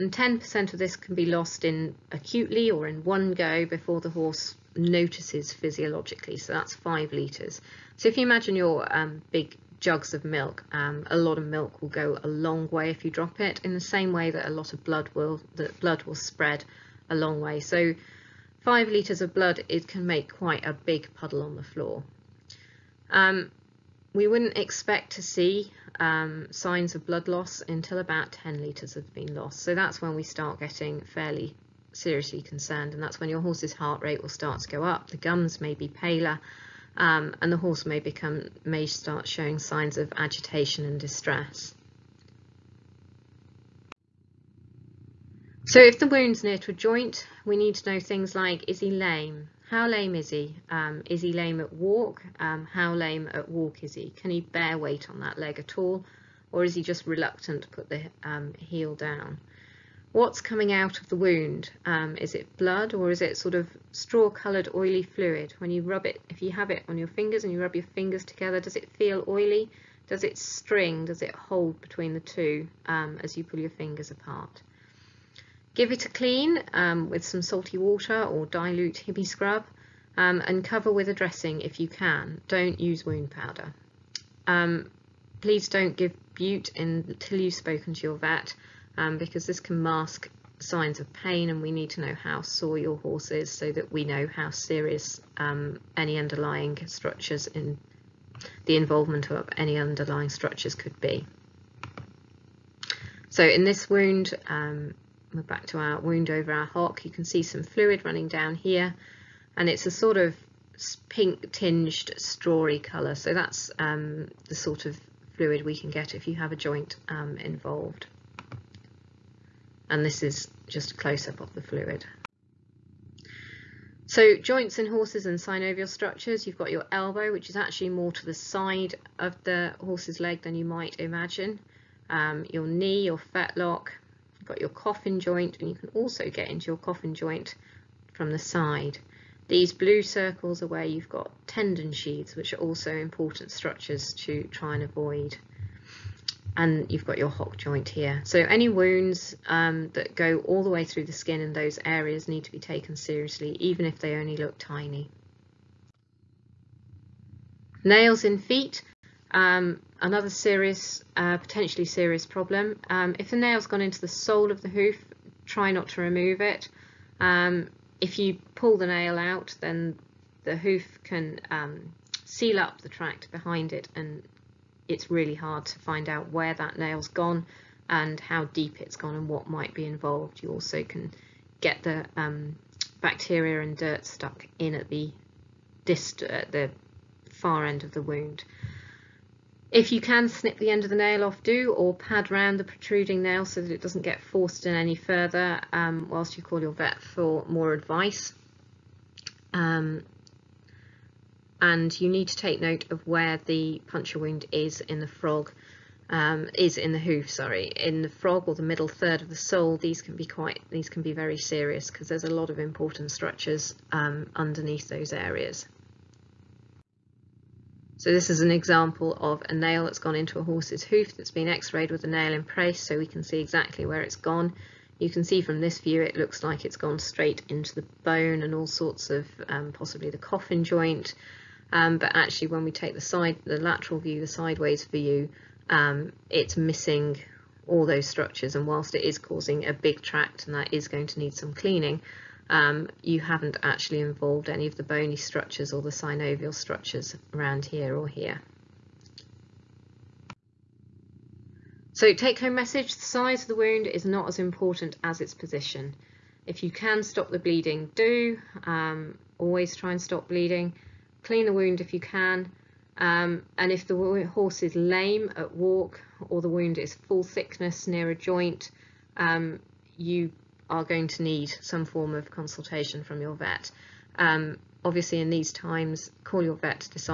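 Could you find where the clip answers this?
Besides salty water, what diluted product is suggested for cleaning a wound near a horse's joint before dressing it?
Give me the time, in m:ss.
1:19.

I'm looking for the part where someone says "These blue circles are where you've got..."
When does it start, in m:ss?
2:19.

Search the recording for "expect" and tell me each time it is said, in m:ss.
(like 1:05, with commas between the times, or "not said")
0:24.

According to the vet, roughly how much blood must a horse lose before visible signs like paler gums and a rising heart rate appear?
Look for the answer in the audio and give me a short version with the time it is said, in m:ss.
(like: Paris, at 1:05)
10 litres, at 0:28.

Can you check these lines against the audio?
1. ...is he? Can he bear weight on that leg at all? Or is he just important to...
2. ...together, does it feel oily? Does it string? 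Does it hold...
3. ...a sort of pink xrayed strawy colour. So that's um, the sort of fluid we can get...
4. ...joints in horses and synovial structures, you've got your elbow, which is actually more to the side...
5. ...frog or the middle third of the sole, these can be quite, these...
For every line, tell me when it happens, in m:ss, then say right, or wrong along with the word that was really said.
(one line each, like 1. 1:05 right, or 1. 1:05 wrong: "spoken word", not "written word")
1. 0:53 wrong: "reluctant", not "important"
2. 1:08 right
3. 1:49 wrong: "tinged", not "xrayed"
4. 2:04 right
5. 3:28 right.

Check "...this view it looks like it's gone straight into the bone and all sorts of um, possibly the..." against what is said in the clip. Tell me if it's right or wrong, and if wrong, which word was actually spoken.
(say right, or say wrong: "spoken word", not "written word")
right.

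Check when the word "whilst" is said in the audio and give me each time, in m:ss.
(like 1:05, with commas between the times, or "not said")
3:16, 3:58.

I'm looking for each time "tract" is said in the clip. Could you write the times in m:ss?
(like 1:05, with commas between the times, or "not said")
2:52, 4:00.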